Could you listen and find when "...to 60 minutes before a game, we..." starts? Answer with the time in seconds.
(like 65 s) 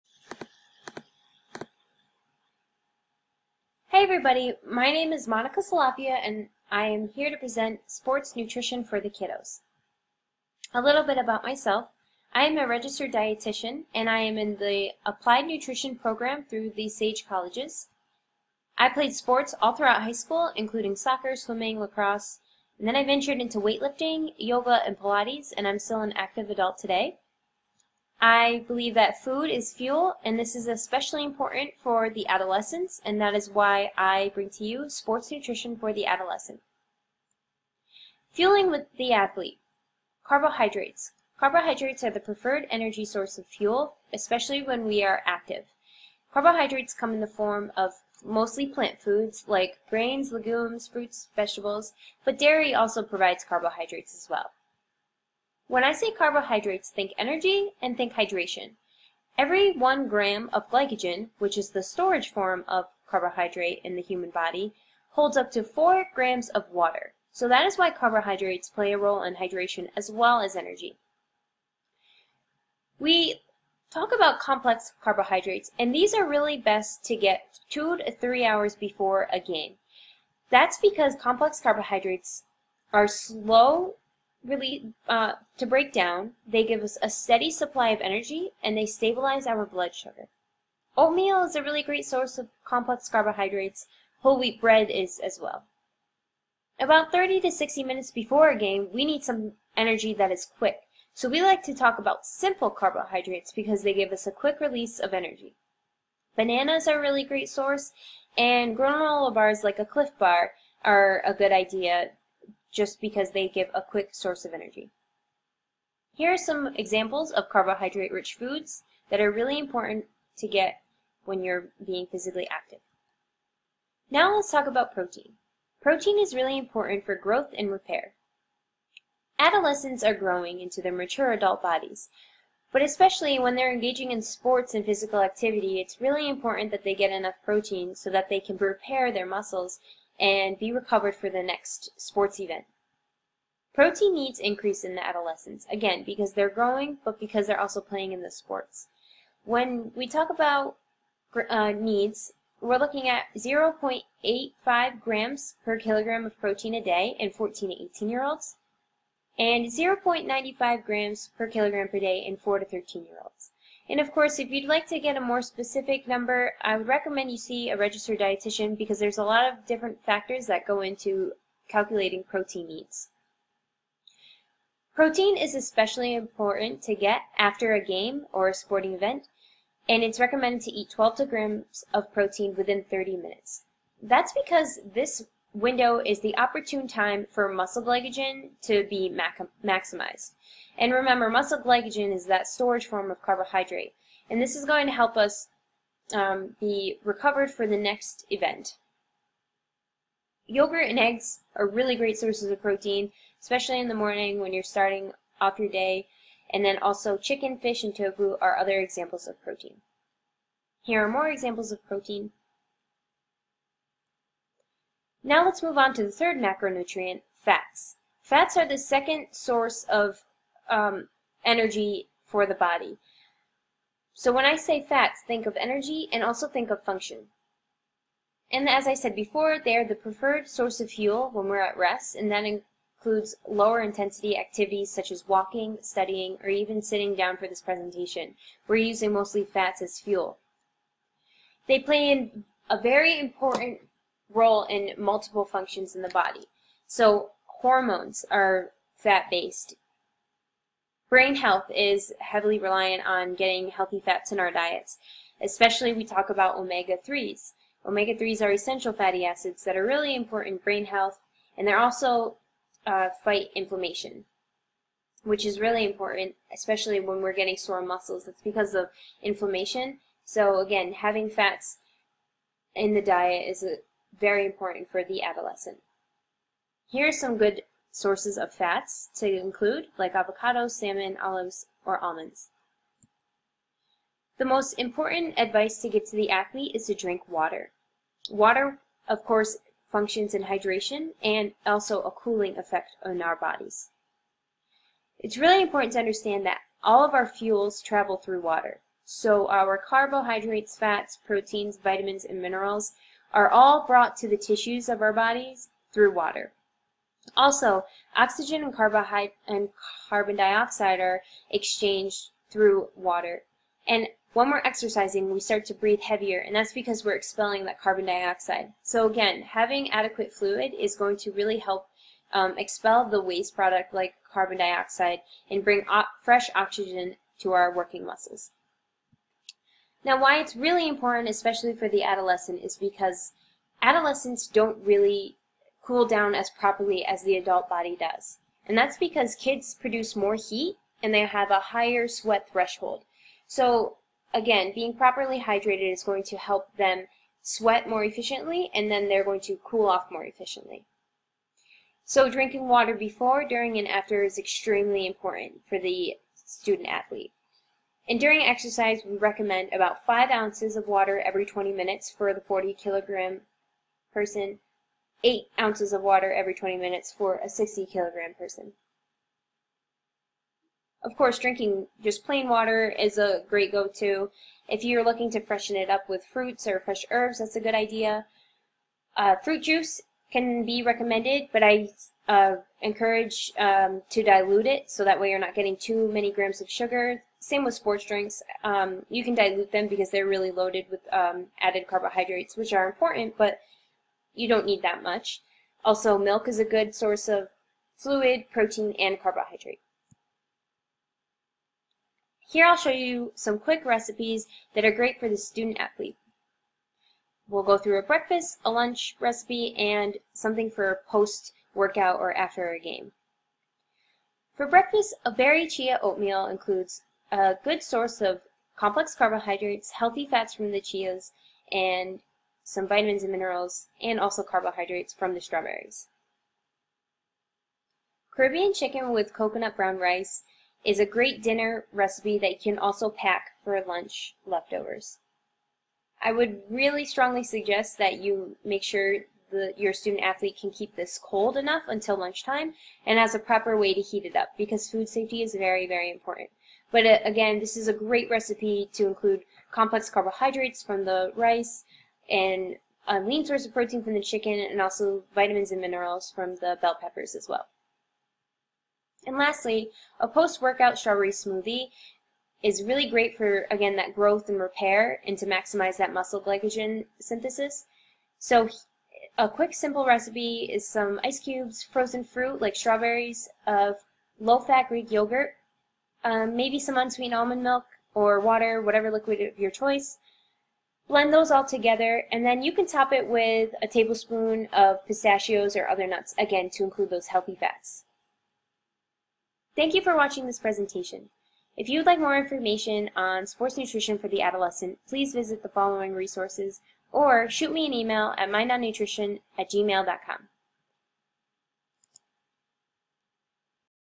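97 s.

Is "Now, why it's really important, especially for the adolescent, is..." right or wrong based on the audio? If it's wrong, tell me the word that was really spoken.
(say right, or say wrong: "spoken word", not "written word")
right.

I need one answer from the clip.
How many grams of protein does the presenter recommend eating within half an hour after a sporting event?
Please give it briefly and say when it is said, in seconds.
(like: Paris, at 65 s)
12 grams, at 180 s.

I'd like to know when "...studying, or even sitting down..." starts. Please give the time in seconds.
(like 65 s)
235 s.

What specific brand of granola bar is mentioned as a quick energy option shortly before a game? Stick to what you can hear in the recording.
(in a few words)
Clif Bar.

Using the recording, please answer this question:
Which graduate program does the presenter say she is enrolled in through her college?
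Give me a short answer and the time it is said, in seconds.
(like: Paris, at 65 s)
applied nutrition, at 15 s.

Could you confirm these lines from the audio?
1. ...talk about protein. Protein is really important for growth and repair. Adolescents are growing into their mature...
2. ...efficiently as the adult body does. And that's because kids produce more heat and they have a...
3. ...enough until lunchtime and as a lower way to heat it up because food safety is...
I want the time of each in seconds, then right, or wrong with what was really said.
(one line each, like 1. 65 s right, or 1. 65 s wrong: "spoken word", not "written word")
1. 124 s right
2. 336 s wrong: "properly", not "efficiently"
3. 441 s wrong: "proper", not "lower".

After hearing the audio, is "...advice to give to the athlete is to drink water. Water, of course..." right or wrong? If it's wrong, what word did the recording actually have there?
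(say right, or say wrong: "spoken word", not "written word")
right.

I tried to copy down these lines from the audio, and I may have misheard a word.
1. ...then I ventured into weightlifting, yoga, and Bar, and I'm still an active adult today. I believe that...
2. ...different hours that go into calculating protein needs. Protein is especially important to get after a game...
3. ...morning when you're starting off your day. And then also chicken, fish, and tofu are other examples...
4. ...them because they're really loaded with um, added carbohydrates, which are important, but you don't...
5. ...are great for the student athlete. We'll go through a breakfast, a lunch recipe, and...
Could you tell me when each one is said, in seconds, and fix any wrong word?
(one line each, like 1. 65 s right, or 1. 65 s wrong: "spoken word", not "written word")
1. 22 s wrong: "Pilates", not "Bar"
2. 169 s wrong: "factors", not "hours"
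3. 203 s right
4. 389 s right
5. 404 s right.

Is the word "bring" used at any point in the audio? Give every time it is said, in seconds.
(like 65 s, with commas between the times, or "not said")
34 s, 325 s.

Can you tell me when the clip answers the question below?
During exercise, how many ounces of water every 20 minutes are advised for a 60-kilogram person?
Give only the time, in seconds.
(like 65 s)
365 s.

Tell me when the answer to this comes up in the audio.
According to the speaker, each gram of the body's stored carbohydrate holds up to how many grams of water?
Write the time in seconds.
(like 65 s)
65 s.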